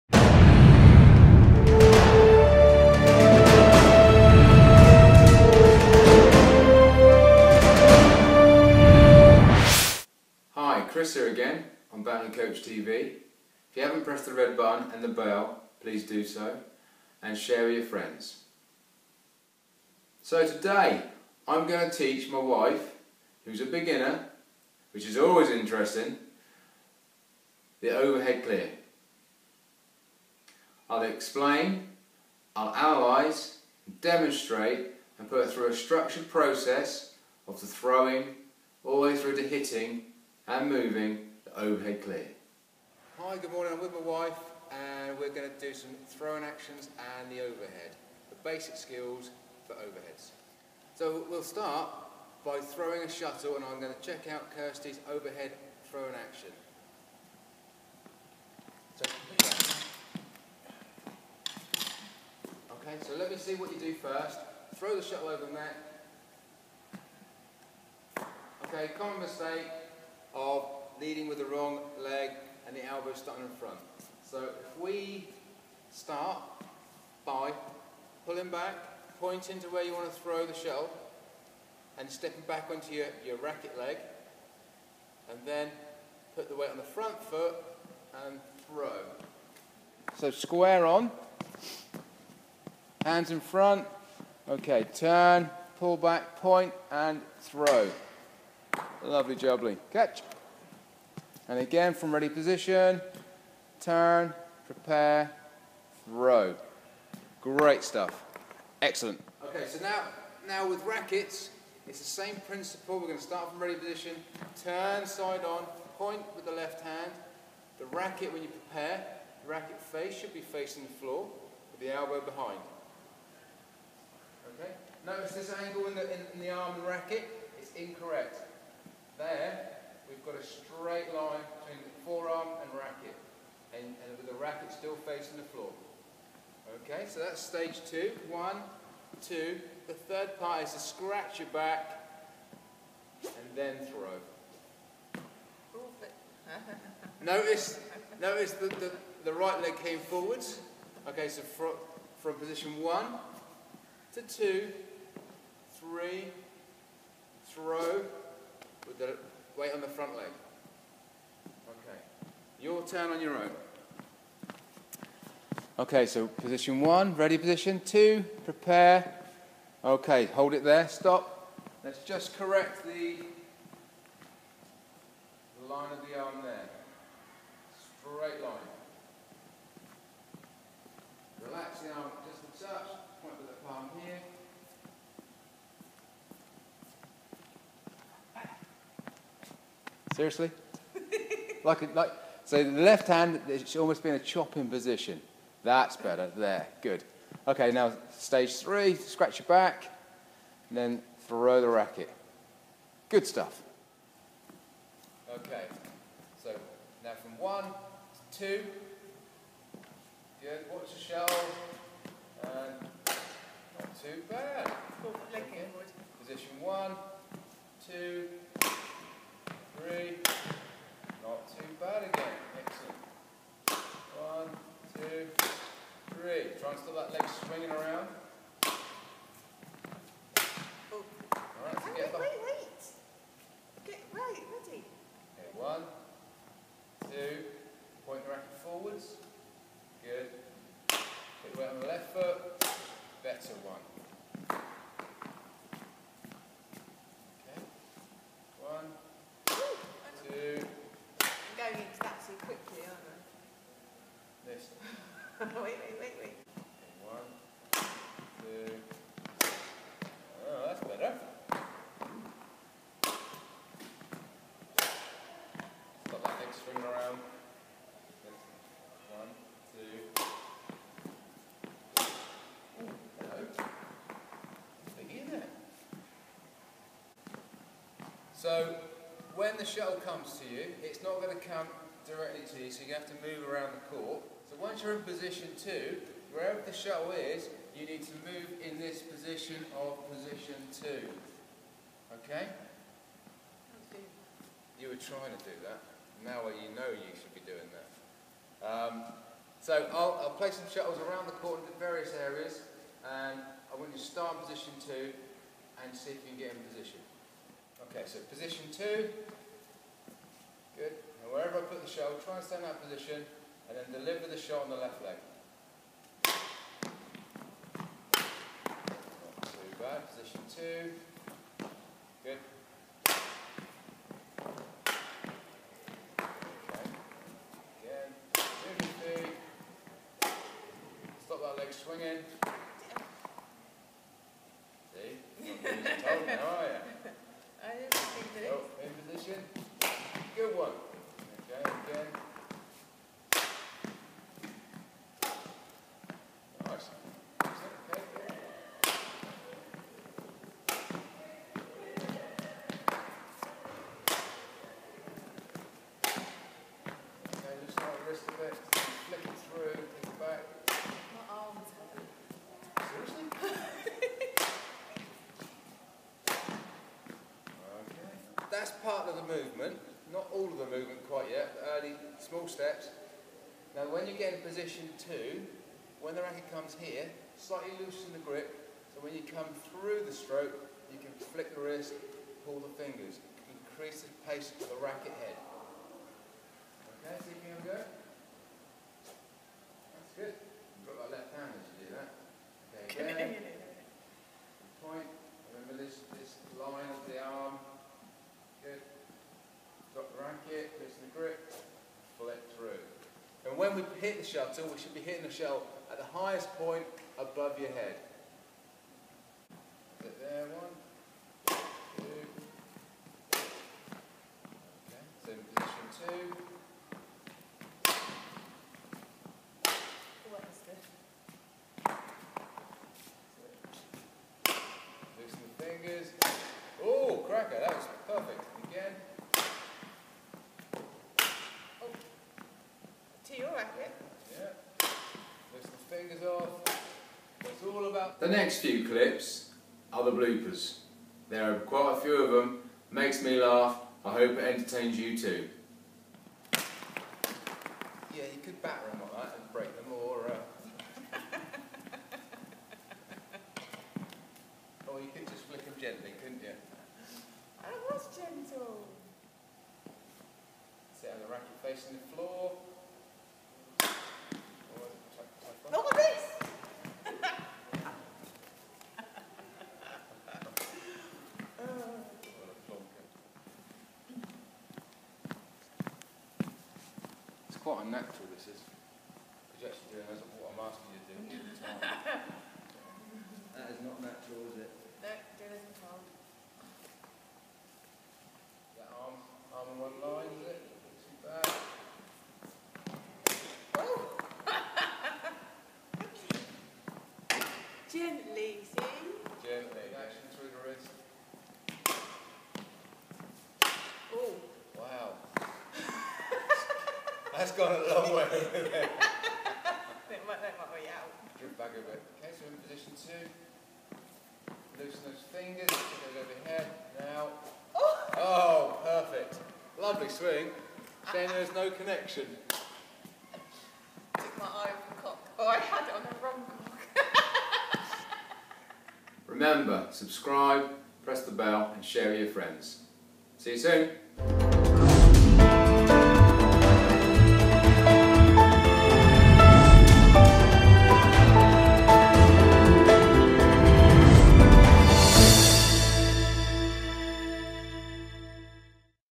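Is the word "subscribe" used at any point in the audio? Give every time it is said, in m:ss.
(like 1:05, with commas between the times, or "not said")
8:49.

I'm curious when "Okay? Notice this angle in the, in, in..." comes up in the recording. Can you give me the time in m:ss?
2:04.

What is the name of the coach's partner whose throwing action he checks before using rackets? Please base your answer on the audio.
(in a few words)
Kirsty.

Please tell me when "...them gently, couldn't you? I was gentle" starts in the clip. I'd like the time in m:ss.
7:35.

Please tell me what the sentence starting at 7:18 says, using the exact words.
The next few clips are the bloopers.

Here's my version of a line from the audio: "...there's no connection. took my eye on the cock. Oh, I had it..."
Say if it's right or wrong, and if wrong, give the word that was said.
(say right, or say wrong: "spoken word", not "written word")
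right.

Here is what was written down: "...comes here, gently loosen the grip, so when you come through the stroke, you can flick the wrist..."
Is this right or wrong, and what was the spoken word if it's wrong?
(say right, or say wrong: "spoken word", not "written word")
wrong: "slightly", not "gently".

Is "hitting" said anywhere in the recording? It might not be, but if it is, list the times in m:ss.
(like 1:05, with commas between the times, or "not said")
0:39, 6:44.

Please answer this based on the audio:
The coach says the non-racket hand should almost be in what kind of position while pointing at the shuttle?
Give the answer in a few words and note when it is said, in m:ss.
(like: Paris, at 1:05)
chopping position, at 3:14.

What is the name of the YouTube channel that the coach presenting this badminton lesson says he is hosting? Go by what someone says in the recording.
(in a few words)
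Badminton Coach TV.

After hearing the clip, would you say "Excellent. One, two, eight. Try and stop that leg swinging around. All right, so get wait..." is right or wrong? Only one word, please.
wrong.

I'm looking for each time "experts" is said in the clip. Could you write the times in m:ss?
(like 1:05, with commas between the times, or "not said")
not said.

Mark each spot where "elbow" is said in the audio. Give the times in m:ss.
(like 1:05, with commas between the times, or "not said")
1:12, 2:01.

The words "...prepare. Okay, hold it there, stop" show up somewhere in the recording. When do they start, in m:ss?
2:48.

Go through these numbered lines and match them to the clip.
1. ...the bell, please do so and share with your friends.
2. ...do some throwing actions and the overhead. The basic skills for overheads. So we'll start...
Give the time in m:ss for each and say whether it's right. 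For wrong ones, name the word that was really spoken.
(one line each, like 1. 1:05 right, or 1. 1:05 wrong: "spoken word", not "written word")
1. 0:15 right
2. 0:45 right.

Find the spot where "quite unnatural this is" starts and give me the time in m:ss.
7:57.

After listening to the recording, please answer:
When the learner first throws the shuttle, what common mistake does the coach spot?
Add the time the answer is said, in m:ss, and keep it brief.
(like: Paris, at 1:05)
wrong leg, at 1:11.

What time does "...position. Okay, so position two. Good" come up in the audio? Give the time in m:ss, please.
5:06.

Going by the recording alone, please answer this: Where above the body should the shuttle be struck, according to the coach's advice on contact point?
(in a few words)
highest point.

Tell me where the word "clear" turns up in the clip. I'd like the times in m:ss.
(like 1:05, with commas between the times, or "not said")
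0:28, 0:42.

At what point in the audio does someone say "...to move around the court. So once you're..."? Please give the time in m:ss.
4:43.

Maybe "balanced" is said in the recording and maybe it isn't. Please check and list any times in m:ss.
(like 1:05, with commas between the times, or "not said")
not said.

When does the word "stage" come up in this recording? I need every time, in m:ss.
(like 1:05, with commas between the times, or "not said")
2:17, 3:18.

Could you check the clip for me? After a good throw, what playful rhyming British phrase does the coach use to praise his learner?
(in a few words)
Lovely jubbly.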